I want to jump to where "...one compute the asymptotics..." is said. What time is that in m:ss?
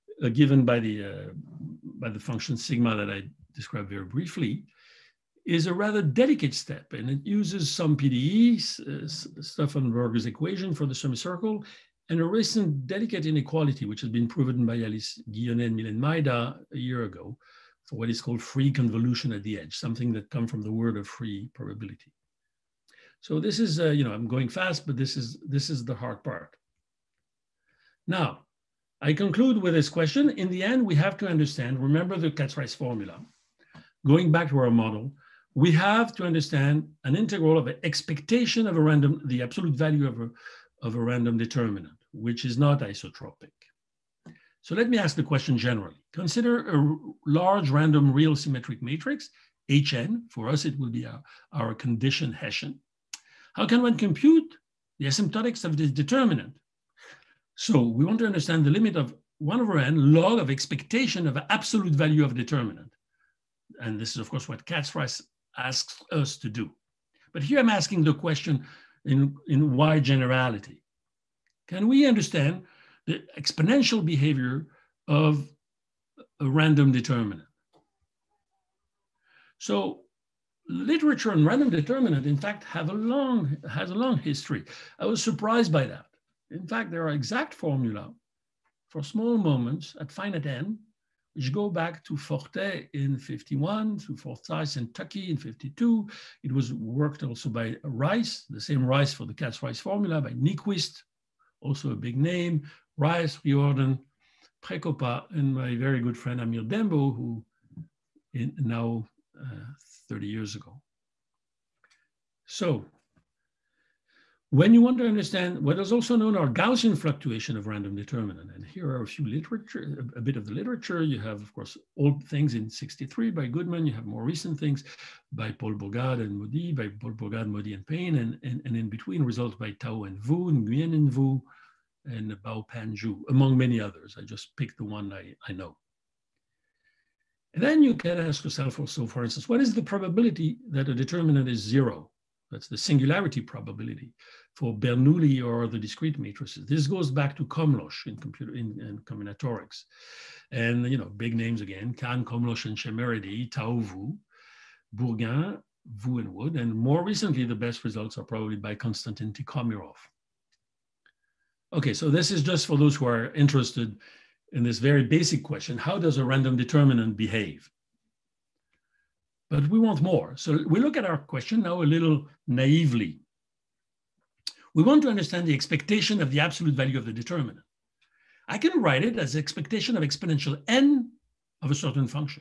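0:53.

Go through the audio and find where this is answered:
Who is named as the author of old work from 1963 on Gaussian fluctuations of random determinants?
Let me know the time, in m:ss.
2:03.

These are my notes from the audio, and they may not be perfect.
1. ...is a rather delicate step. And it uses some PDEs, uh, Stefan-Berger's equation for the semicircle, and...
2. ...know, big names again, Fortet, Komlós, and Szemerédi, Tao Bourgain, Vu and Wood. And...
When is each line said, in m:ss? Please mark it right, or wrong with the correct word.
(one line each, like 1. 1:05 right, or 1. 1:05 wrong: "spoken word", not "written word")
1. 0:05 right
2. 2:30 wrong: "Kahn", not "Fortet".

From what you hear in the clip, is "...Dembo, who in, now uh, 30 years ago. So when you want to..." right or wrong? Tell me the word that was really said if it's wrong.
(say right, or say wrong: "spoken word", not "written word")
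right.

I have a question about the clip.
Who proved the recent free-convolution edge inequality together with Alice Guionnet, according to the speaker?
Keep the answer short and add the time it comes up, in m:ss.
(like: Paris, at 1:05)
Mylène Maïda, at 0:15.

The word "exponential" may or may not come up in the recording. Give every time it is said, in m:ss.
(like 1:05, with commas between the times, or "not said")
1:13, 3:00.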